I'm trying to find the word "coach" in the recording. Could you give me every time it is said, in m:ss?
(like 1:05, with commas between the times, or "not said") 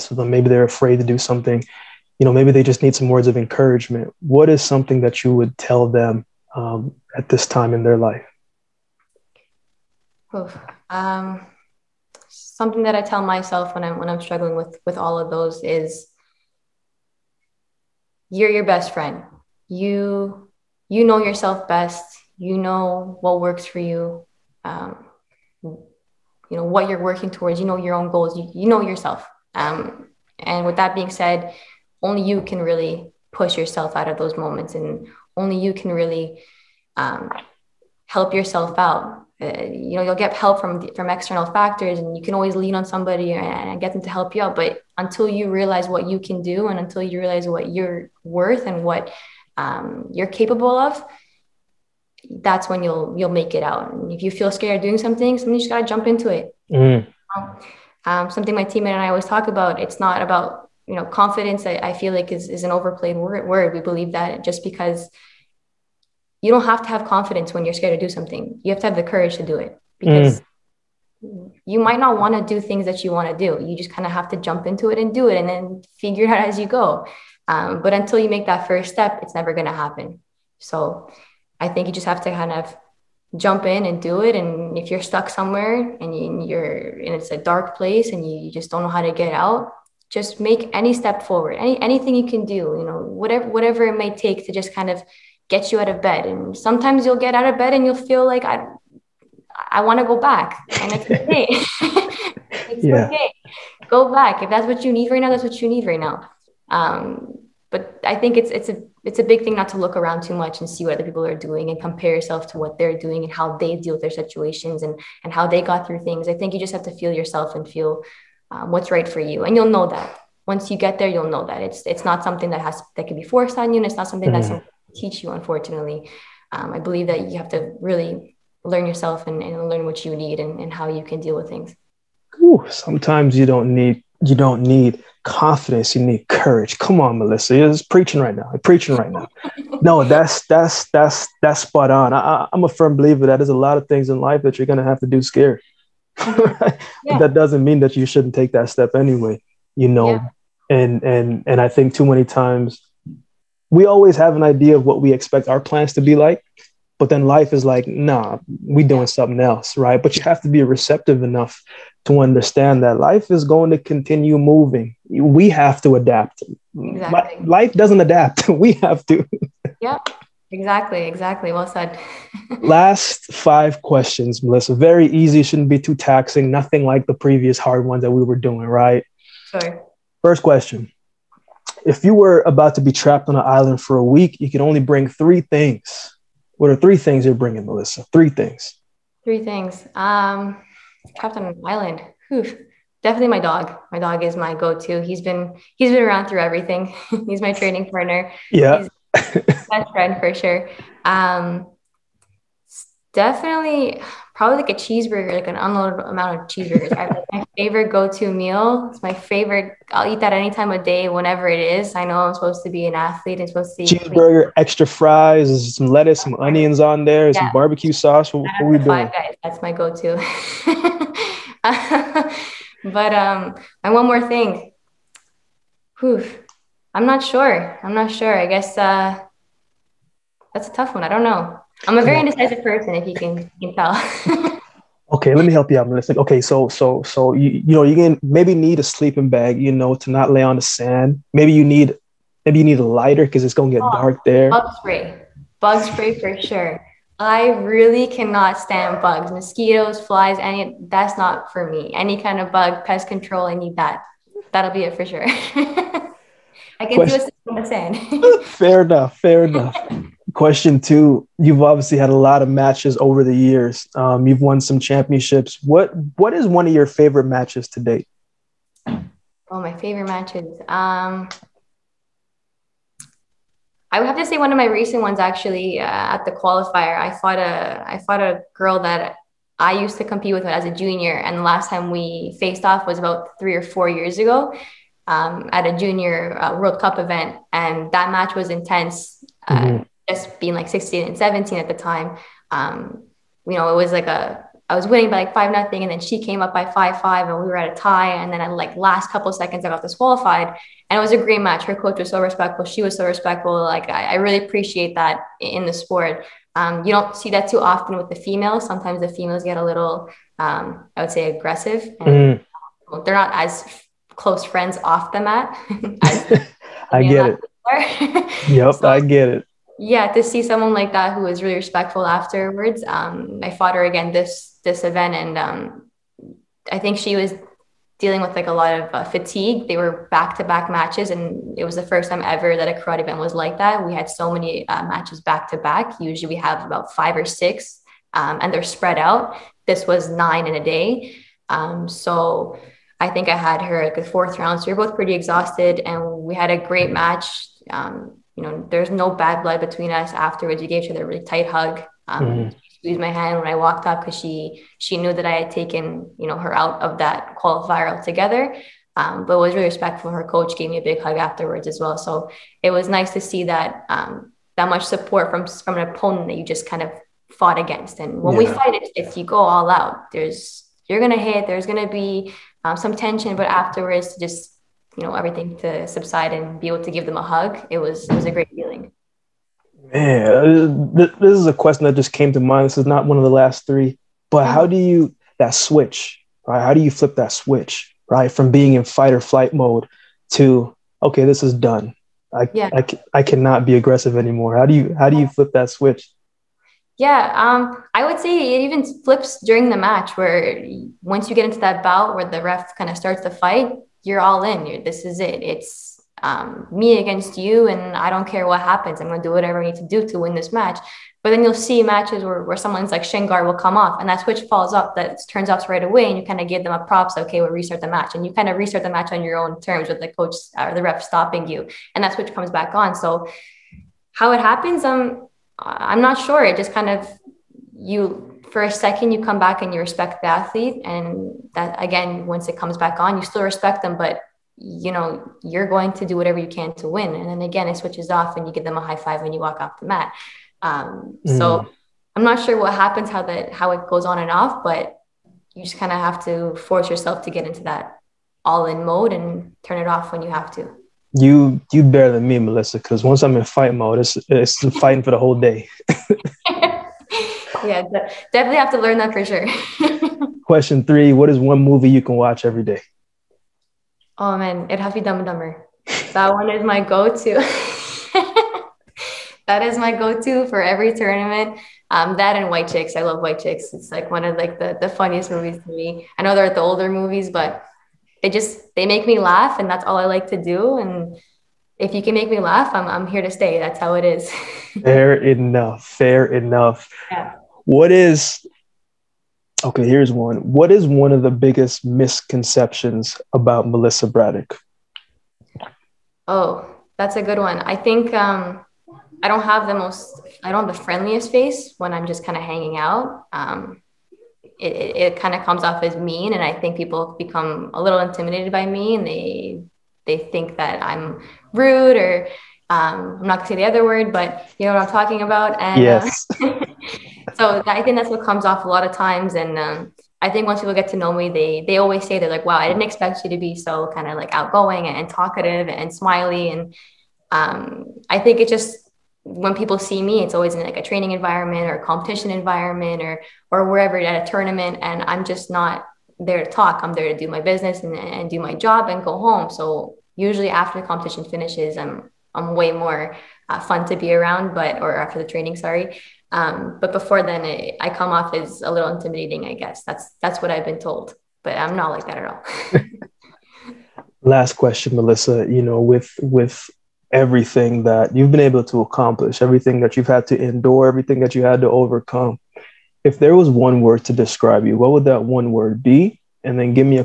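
5:01, 6:00, 7:00.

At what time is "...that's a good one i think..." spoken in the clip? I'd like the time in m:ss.
8:16.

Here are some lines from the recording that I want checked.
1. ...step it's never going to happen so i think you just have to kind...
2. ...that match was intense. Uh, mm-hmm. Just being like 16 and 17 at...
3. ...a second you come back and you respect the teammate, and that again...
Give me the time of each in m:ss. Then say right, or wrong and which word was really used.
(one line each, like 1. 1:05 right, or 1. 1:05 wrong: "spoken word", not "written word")
1. 1:18 right
2. 4:47 right
3. 7:08 wrong: "athlete", not "teammate".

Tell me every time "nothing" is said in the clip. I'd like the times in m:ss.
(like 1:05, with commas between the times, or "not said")
2:56, 4:55.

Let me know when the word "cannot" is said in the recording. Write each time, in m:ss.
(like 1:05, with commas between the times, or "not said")
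4:08, 6:33.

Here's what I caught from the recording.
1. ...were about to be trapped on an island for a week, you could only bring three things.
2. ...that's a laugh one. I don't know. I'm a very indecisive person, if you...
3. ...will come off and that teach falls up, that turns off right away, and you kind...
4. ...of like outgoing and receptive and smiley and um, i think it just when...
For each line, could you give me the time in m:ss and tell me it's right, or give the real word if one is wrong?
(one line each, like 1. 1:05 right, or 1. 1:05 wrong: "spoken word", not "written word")
1. 3:02 right
2. 3:50 wrong: "tough", not "laugh"
3. 6:53 wrong: "switch", not "teach"
4. 8:44 wrong: "talkative", not "receptive".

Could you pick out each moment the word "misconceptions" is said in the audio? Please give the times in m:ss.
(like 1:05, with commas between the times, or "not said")
8:11.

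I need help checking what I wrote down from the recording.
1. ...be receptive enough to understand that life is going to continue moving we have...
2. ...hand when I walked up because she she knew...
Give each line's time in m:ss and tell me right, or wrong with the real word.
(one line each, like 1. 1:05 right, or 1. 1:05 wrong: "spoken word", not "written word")
1. 2:40 right
2. 5:53 right.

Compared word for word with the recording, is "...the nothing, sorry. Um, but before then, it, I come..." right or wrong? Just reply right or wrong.
wrong.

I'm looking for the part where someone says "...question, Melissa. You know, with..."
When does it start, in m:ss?
9:14.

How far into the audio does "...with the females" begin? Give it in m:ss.
5:07.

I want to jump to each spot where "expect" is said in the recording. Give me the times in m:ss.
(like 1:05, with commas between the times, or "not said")
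2:35, 8:42.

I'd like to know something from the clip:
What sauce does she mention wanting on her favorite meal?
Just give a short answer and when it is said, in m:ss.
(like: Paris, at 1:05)
Barbecue sauce, at 3:37.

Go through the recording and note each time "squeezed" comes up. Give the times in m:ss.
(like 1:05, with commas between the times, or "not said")
5:52.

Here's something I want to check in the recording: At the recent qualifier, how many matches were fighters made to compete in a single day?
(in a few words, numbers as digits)
9.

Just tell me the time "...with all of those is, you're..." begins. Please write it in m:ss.
0:14.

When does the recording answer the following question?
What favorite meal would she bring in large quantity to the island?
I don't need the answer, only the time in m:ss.
3:26.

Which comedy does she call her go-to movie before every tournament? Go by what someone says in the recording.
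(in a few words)
Dumb and Dumber.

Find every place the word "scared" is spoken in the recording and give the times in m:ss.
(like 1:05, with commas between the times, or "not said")
0:54, 1:07, 2:25.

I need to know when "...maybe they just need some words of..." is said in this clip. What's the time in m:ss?
0:02.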